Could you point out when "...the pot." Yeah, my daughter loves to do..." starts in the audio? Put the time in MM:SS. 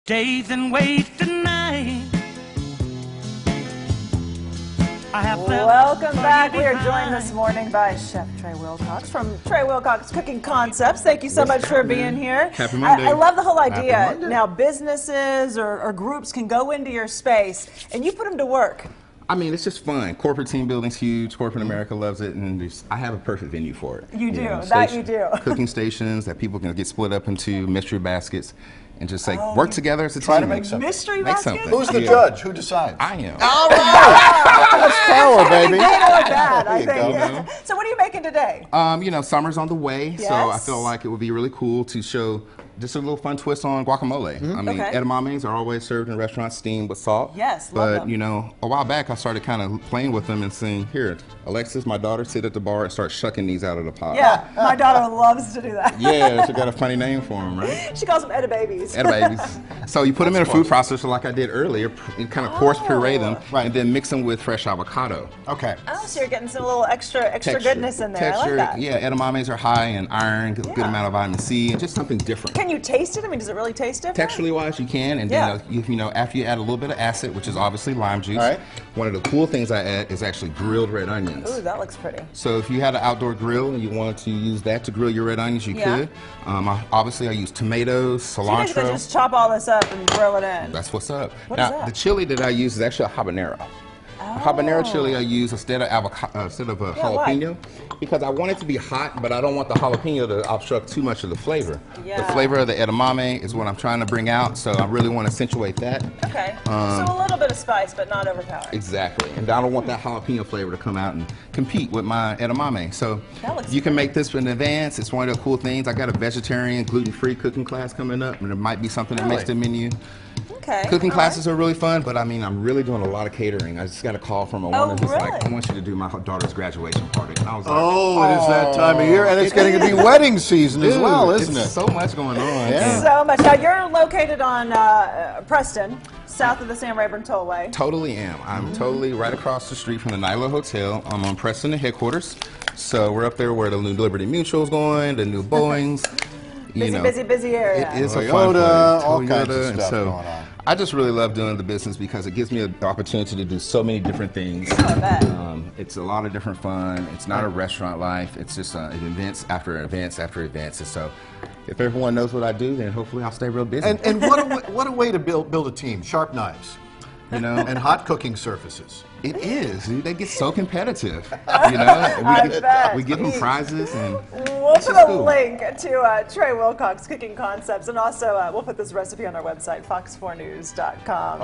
00:53.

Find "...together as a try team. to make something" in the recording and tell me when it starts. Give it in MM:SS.
00:29.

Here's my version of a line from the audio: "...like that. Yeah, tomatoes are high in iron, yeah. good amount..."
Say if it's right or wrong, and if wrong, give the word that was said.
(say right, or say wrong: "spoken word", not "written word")
wrong: "edamames", not "tomatoes".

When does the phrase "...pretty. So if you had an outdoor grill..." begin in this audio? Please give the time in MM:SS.
01:21.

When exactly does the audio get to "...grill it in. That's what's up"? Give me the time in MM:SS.
01:30.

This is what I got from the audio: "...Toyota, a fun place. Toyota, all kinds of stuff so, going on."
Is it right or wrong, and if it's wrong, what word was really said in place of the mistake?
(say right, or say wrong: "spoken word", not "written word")
right.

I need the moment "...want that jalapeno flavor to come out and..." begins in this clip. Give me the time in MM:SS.
01:49.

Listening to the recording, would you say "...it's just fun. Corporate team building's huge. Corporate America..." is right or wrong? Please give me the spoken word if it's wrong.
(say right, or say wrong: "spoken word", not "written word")
right.